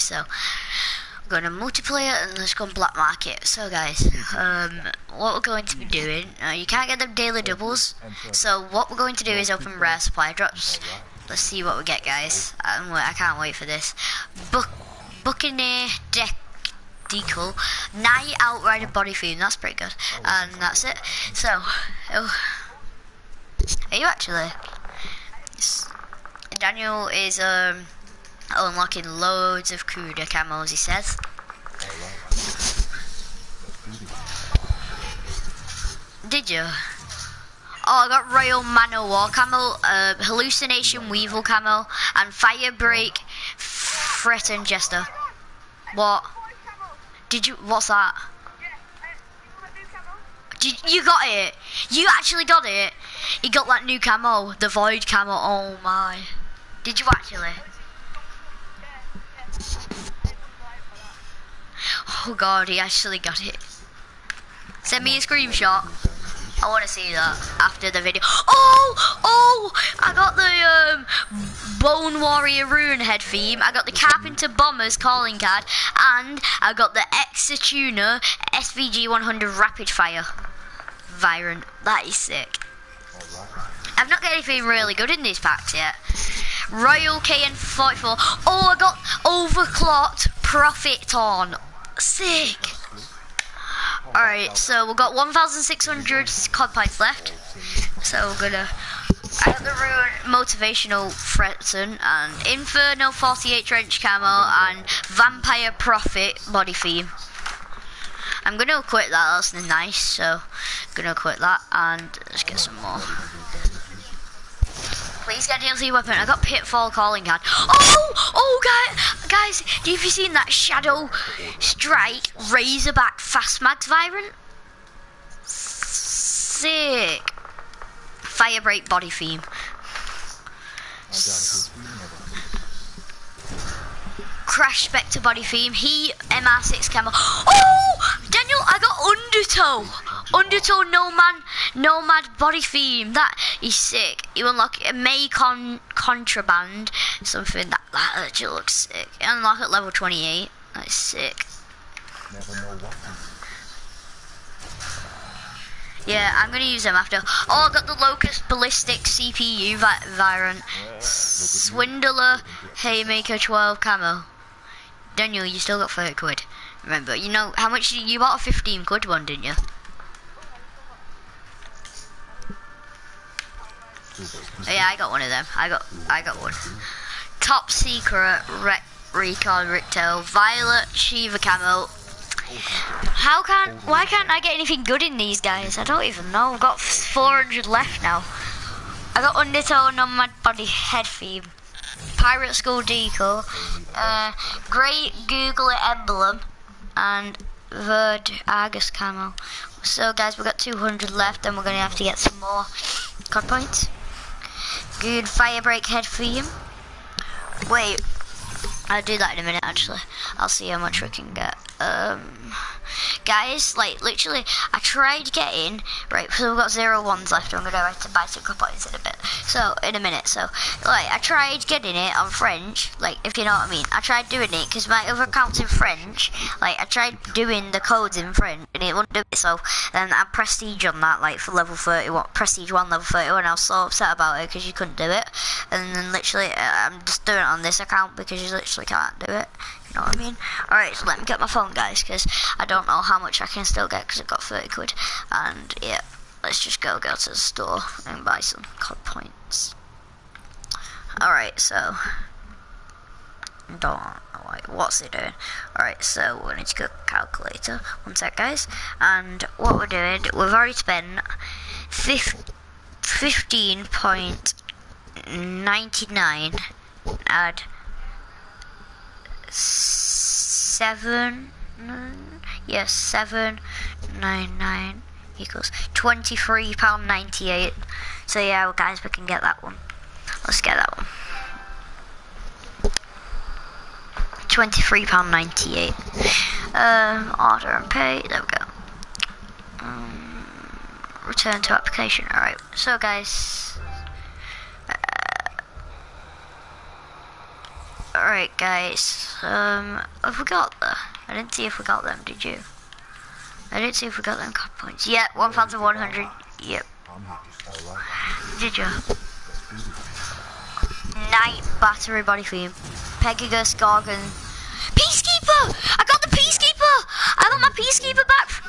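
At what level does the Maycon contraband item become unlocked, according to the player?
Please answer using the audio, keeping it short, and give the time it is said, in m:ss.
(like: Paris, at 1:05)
28, at 2:29.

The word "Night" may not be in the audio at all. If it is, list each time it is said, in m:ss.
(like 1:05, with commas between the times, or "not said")
0:17, 5:11.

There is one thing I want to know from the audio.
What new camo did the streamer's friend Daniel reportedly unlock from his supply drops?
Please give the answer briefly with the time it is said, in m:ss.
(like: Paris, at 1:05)
Void camo, at 0:54.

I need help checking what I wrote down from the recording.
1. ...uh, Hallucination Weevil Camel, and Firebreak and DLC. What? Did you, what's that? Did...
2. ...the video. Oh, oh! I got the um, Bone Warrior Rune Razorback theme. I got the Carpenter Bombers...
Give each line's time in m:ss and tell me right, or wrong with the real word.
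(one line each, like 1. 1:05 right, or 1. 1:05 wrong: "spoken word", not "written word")
1. 0:39 wrong: "Jester", not "DLC"
2. 1:07 wrong: "Head", not "Razorback".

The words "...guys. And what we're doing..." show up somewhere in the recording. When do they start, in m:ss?
4:18.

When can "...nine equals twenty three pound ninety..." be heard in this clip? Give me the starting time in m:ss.
4:34.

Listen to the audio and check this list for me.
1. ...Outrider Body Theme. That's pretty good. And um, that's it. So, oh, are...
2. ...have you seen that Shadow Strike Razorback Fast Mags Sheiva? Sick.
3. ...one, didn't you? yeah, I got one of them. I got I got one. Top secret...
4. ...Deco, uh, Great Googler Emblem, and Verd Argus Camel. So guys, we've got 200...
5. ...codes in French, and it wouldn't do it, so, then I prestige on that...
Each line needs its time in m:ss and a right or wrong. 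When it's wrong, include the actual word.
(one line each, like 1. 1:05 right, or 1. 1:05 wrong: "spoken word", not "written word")
1. 0:18 right
2. 1:59 wrong: "Vibrant", not "Sheiva"
3. 2:49 right
4. 3:12 right
5. 3:47 right.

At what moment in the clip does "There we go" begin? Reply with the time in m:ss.
4:48.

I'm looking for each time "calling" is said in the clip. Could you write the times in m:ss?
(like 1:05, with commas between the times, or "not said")
1:14, 1:56.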